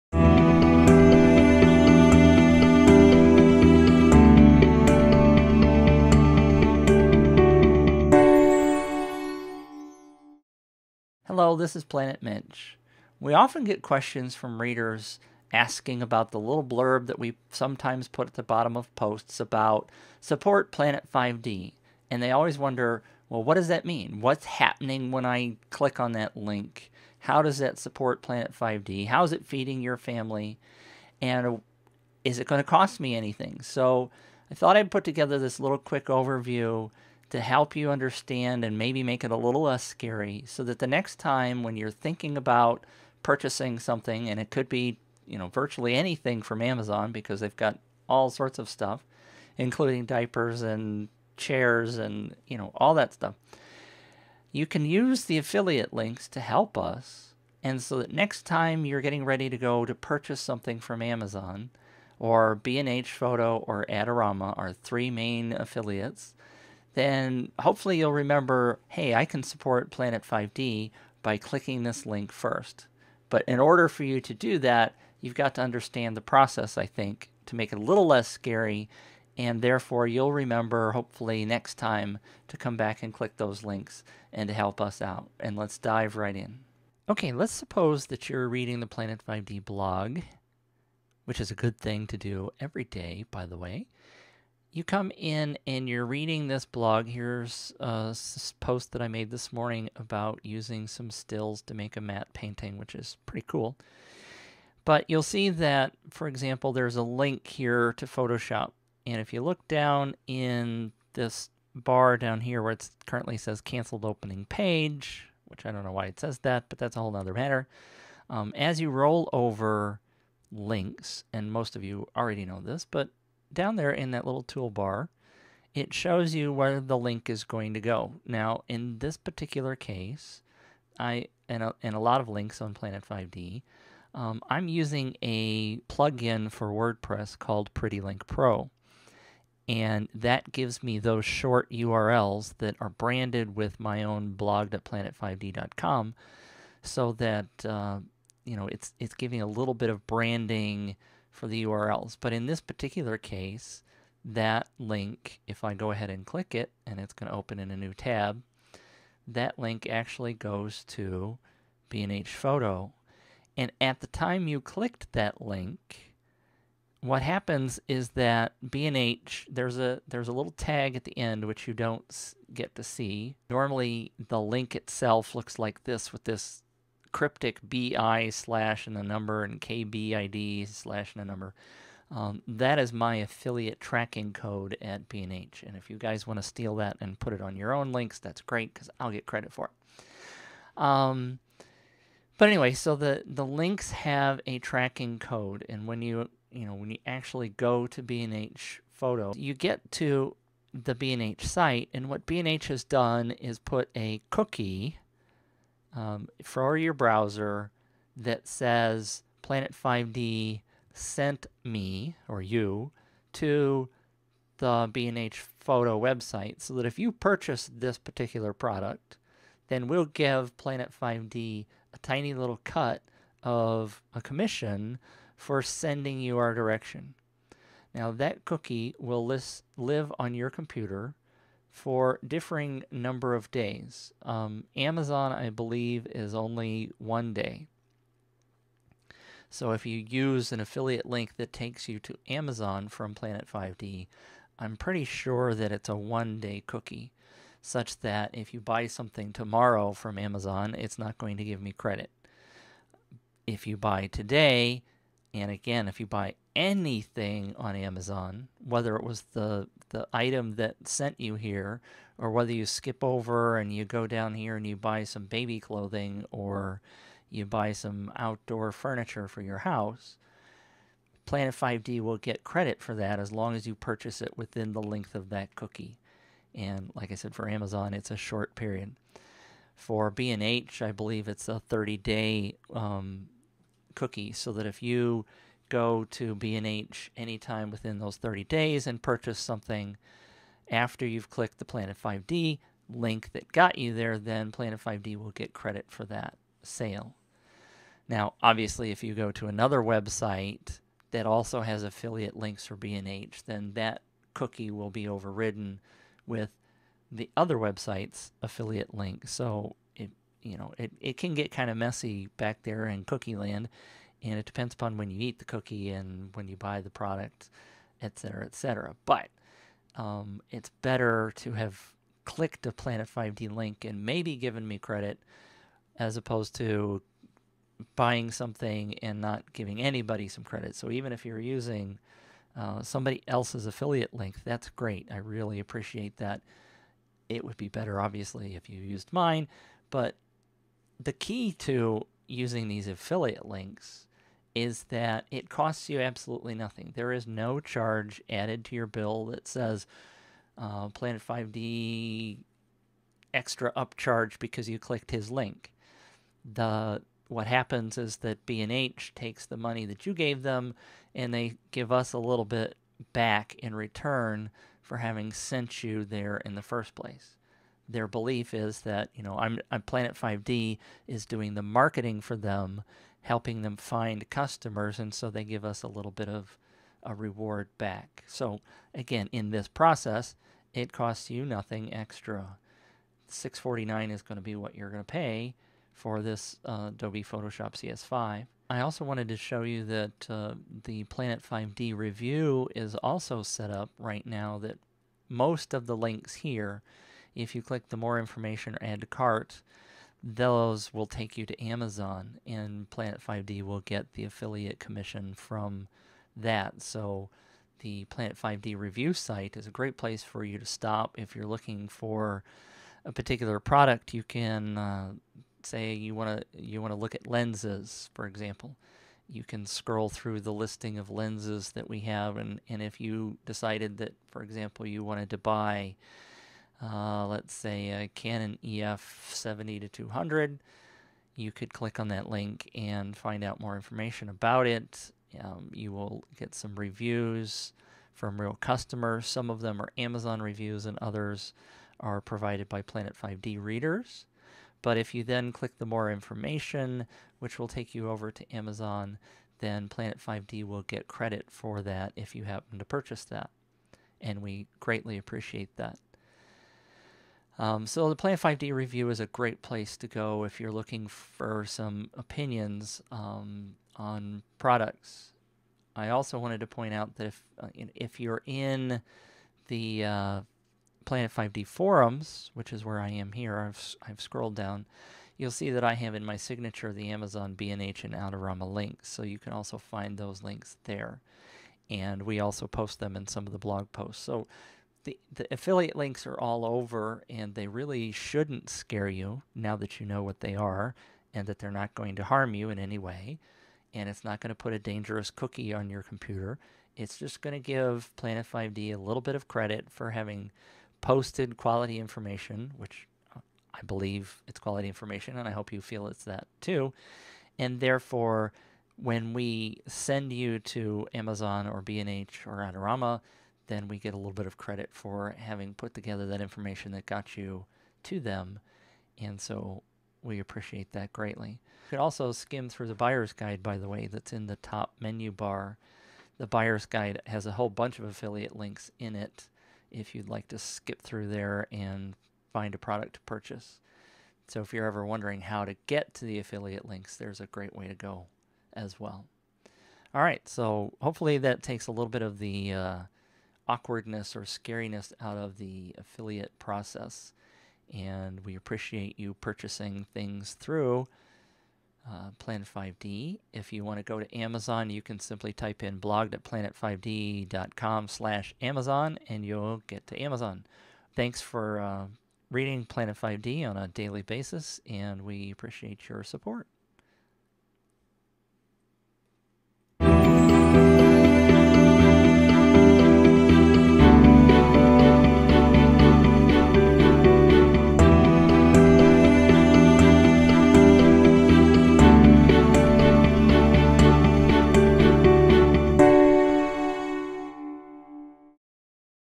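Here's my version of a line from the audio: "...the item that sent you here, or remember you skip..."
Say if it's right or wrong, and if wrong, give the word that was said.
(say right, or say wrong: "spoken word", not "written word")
wrong: "whether", not "remember".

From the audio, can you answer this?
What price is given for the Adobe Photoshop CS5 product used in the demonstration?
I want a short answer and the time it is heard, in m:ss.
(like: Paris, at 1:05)
649, at 6:23.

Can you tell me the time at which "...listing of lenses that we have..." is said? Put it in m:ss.
7:00.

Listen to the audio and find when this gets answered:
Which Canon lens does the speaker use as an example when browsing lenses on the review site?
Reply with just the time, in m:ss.
7:08.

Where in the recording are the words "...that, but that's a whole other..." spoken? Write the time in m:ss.
1:56.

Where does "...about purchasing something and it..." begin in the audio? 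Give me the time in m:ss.
0:42.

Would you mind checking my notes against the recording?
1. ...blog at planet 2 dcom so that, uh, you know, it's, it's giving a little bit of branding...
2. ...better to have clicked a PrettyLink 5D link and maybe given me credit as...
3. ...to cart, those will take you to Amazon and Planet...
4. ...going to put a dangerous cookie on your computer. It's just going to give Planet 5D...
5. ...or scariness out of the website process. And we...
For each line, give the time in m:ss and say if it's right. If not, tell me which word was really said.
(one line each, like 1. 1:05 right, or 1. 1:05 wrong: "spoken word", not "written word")
1. 2:24 wrong: "5", not "2"
2. 5:20 wrong: "Planet", not "PrettyLink"
3. 6:39 right
4. 8:14 right
5. 9:04 wrong: "affiliate", not "website".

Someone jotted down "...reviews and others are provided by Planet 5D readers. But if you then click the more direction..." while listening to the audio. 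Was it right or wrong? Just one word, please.
wrong.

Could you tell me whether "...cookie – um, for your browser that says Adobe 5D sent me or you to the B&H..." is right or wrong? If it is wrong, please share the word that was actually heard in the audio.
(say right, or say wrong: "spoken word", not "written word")
wrong: "Planet", not "Adobe".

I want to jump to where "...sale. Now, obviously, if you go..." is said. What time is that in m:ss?
4:56.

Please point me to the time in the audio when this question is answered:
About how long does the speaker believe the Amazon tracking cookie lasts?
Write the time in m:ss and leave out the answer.
3:56.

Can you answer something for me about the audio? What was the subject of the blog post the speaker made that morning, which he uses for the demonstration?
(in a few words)
a matte painting.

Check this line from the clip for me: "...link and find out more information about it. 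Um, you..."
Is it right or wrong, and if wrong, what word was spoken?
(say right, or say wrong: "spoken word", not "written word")
right.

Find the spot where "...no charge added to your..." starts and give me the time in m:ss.
5:47.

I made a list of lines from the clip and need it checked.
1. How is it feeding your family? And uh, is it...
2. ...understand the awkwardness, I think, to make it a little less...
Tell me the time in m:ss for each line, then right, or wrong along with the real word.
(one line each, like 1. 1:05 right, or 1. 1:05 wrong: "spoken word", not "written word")
1. 0:29 right
2. 1:15 wrong: "process", not "awkwardness".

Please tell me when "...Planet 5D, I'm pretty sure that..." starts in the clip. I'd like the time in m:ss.
4:03.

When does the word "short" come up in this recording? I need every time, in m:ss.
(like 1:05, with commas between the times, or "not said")
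2:21, 4:38.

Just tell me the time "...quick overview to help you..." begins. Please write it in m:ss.
0:35.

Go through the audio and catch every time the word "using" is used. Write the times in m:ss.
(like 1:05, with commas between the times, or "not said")
1:40, 2:14, 5:31, 5:42.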